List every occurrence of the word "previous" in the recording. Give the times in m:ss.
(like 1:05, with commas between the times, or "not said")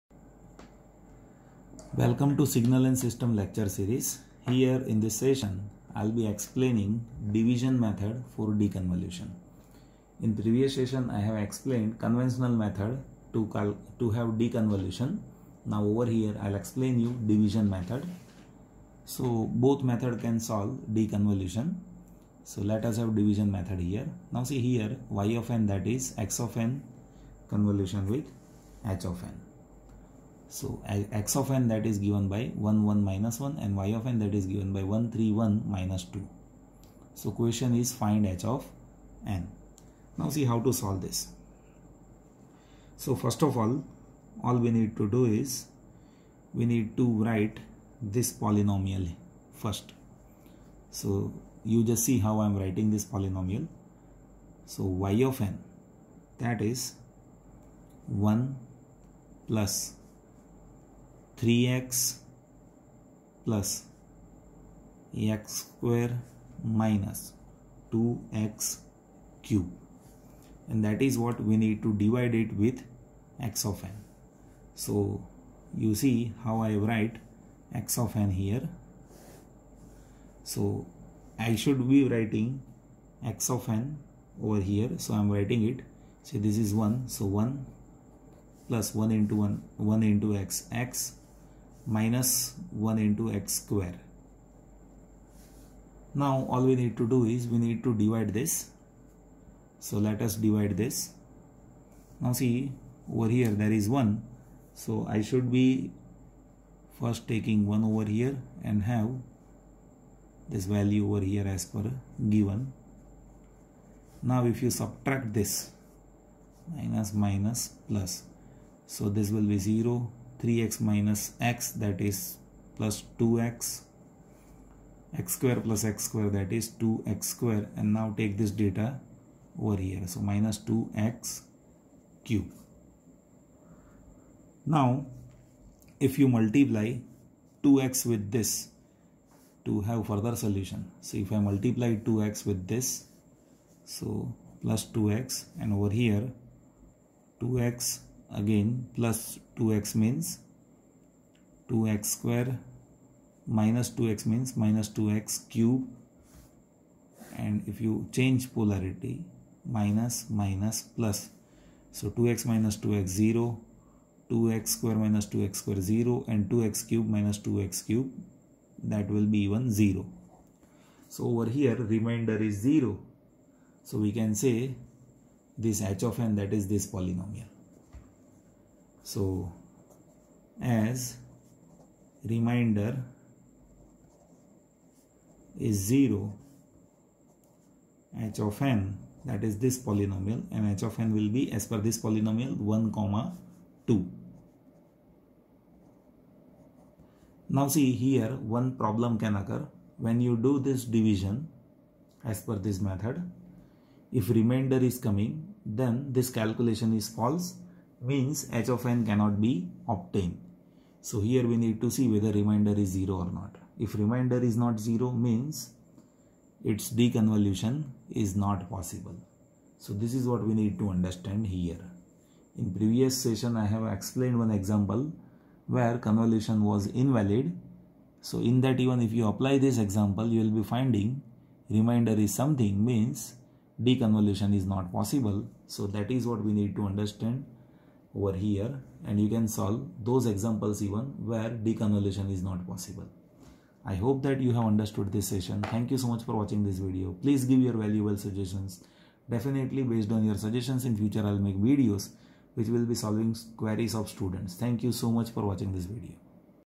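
0:10, 3:42.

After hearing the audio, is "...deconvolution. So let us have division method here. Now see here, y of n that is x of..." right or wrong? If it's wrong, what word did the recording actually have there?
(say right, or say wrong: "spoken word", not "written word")
right.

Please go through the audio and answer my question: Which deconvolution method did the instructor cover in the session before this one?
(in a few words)
Conventional method.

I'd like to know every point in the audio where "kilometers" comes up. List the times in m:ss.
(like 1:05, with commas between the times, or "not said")
not said.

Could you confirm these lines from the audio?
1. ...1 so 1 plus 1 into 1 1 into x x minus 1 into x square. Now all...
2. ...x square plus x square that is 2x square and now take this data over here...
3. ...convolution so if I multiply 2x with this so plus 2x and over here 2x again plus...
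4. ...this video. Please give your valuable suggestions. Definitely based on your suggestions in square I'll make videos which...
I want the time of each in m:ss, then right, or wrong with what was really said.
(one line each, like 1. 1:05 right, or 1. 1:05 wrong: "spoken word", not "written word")
1. 1:26 right
2. 2:05 right
3. 2:20 wrong: "solution", not "convolution"
4. 4:06 wrong: "future", not "square".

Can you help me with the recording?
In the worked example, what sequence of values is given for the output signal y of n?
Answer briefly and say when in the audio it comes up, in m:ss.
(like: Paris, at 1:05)
1, 3, 1, -2, at 0:34.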